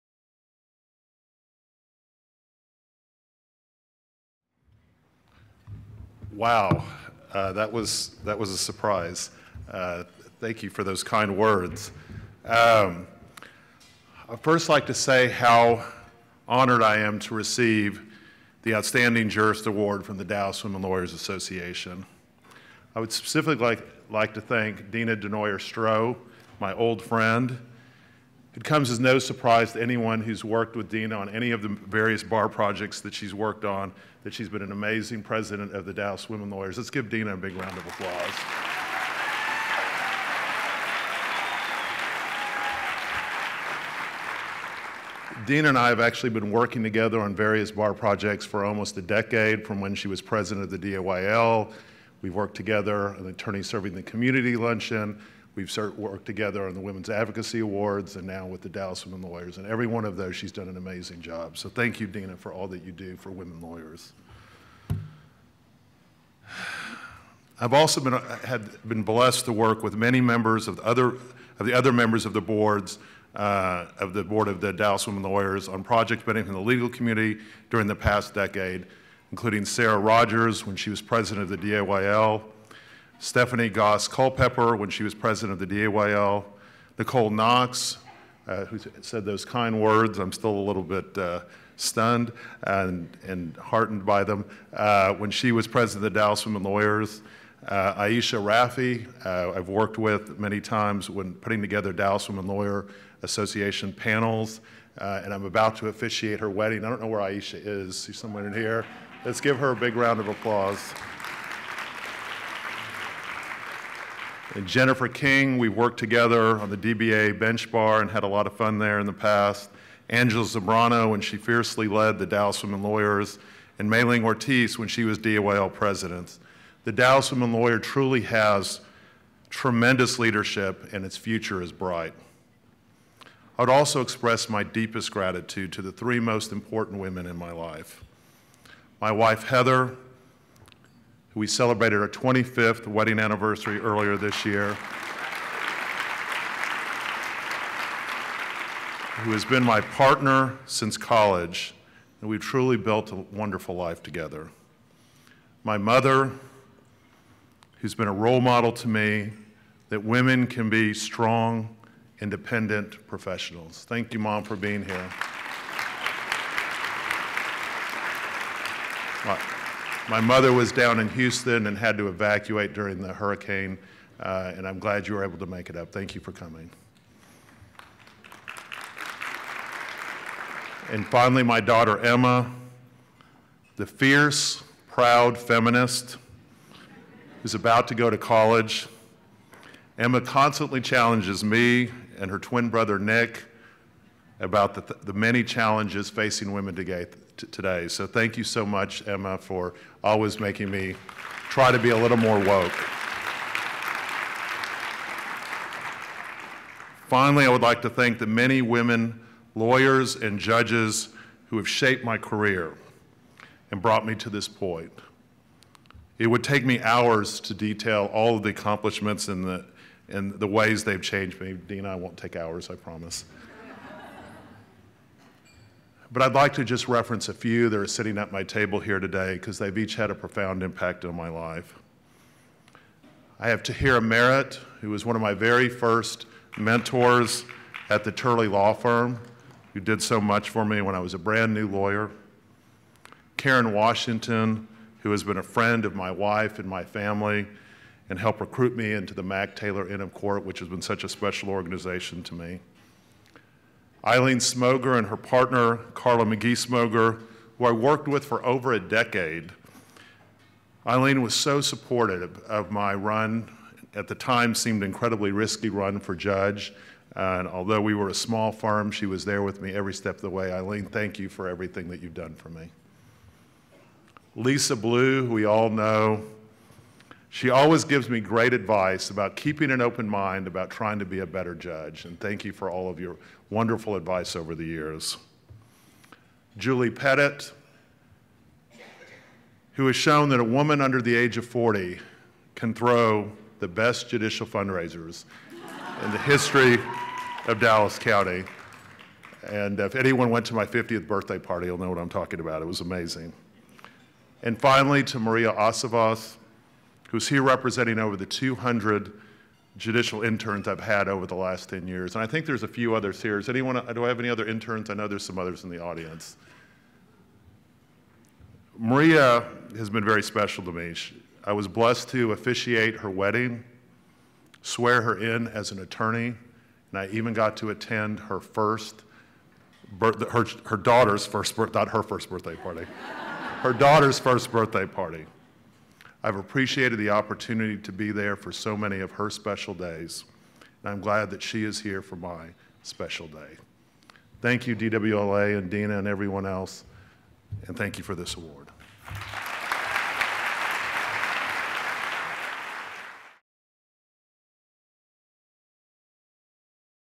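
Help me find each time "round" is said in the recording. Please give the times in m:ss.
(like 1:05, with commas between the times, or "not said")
0:37, 1:49.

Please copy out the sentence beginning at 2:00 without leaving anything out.
Angela Zambrano, when she fiercely led the Dallas Women Lawyers, and Mayling Ortiz when she was DOL president.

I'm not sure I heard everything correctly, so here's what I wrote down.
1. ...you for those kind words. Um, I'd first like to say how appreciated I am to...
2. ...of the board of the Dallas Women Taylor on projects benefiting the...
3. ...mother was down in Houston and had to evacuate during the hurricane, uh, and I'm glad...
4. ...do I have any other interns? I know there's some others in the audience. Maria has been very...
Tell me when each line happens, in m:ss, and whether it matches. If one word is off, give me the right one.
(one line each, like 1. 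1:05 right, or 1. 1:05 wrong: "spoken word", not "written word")
1. 0:10 wrong: "honored", not "appreciated"
2. 1:13 wrong: "Lawyers", not "Taylor"
3. 2:50 right
4. 5:13 right.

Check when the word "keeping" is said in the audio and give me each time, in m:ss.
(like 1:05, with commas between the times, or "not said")
4:39.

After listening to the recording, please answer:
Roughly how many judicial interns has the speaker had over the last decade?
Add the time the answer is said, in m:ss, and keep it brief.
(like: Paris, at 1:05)
200, at 5:08.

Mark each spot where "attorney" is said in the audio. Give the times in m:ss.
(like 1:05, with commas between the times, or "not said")
0:53, 5:25.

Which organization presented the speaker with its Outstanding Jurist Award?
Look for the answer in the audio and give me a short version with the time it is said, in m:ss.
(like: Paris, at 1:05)
Dallas Women Lawyers Association, at 0:20.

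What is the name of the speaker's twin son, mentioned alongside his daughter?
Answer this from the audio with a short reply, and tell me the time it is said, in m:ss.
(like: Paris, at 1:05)
Nick, at 3:12.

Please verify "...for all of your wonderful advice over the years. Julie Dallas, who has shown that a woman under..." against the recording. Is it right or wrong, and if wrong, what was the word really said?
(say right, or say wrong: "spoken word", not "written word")
wrong: "Pettit", not "Dallas".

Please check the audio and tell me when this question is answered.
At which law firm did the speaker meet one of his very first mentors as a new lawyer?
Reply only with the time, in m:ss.
3:58.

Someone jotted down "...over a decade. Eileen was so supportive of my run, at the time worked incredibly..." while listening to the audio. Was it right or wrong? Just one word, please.
wrong.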